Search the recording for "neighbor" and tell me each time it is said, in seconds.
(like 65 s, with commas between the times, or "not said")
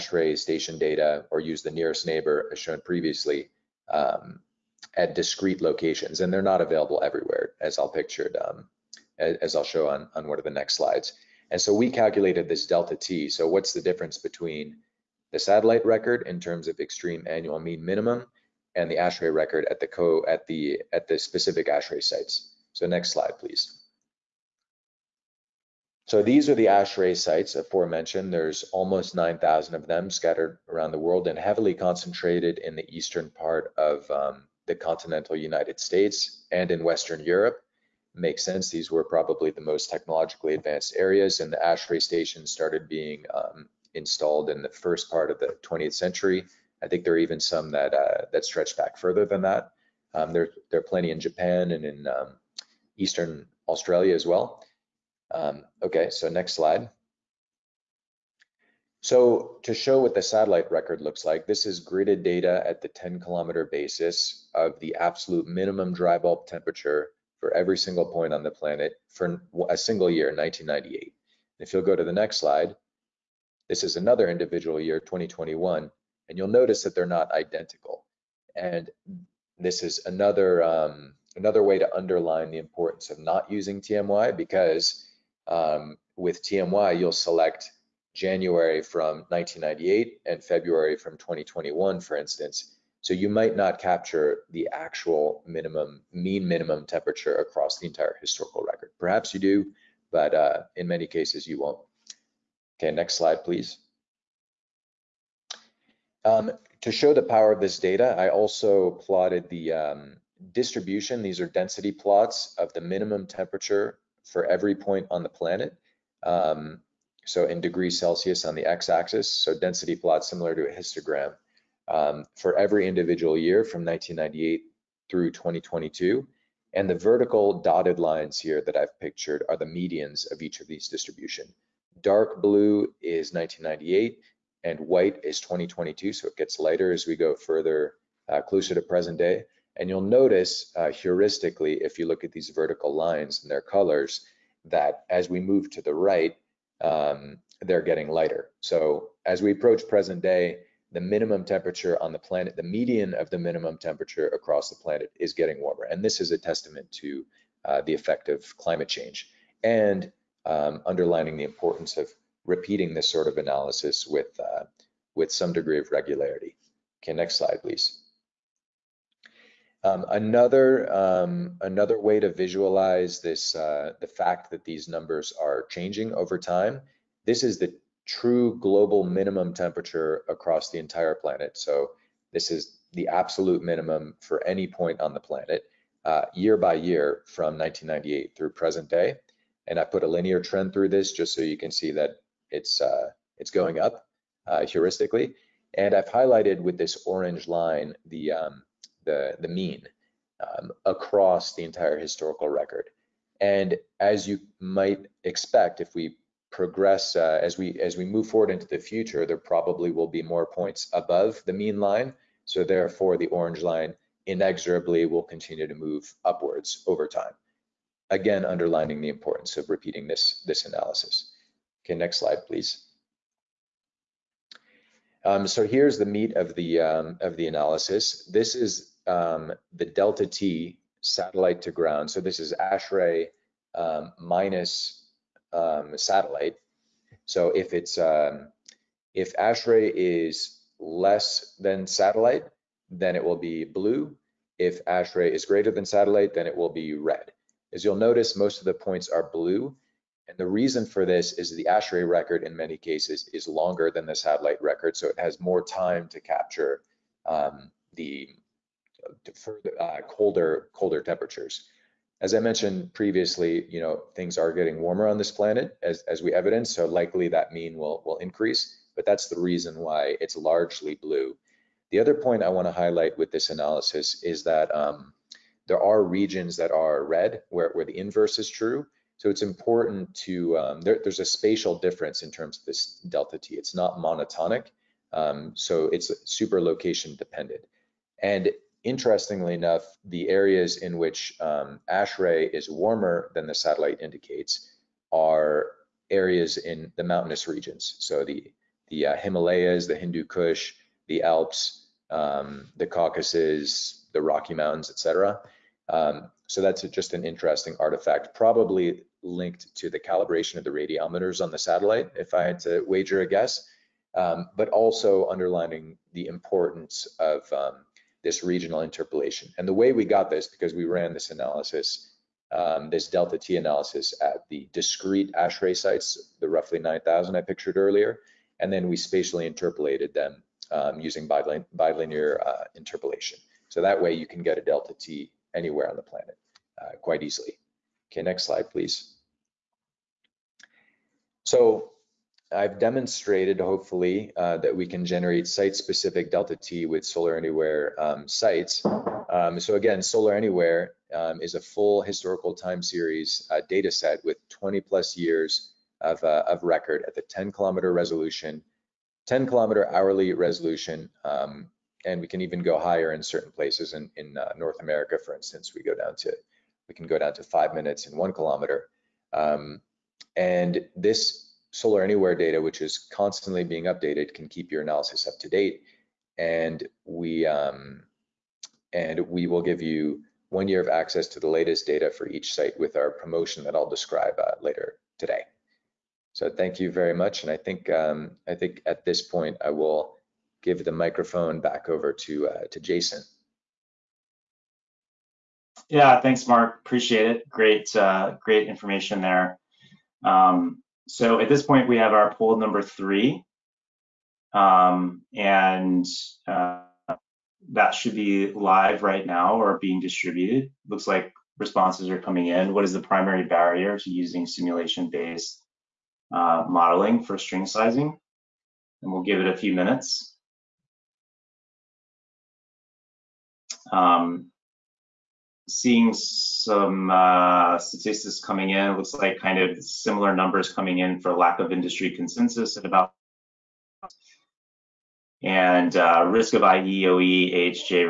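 2 s.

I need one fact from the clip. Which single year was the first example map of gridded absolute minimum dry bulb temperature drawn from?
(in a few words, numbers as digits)
1998.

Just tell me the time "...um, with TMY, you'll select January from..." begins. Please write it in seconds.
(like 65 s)
85 s.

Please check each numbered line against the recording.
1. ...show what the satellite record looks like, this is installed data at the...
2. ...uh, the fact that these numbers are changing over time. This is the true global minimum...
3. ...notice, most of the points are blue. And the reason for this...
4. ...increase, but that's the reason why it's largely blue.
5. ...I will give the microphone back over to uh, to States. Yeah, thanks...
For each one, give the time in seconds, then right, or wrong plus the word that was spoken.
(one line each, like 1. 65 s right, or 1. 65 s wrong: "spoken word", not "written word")
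1. 59 s wrong: "gridded", not "installed"
2. 173 s right
3. 247 s right
4. 268 s right
5. 389 s wrong: "Jason", not "States".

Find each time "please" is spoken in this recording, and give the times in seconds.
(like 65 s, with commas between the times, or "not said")
23 s, 103 s, 167 s, 222 s, 338 s.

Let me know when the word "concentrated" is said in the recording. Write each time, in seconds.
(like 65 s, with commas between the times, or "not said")
31 s.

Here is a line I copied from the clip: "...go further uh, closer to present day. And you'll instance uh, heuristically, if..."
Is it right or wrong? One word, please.
wrong.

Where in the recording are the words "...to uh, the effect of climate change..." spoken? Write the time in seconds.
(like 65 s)
156 s.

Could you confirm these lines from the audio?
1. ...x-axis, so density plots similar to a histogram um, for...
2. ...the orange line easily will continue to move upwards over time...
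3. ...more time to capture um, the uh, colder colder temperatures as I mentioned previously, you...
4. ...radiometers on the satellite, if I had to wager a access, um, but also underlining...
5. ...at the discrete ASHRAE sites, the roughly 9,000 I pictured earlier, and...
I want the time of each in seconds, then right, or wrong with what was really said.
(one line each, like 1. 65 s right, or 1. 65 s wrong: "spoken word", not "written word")
1. 118 s right
2. 213 s wrong: "inexorably", not "easily"
3. 255 s right
4. 310 s wrong: "guess", not "access"
5. 324 s right.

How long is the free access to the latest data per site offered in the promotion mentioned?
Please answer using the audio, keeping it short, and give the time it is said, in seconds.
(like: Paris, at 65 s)
1 year, at 380 s.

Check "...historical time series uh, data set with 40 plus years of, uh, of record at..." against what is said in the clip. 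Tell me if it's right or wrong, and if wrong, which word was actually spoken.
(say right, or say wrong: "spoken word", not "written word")
wrong: "20", not "40".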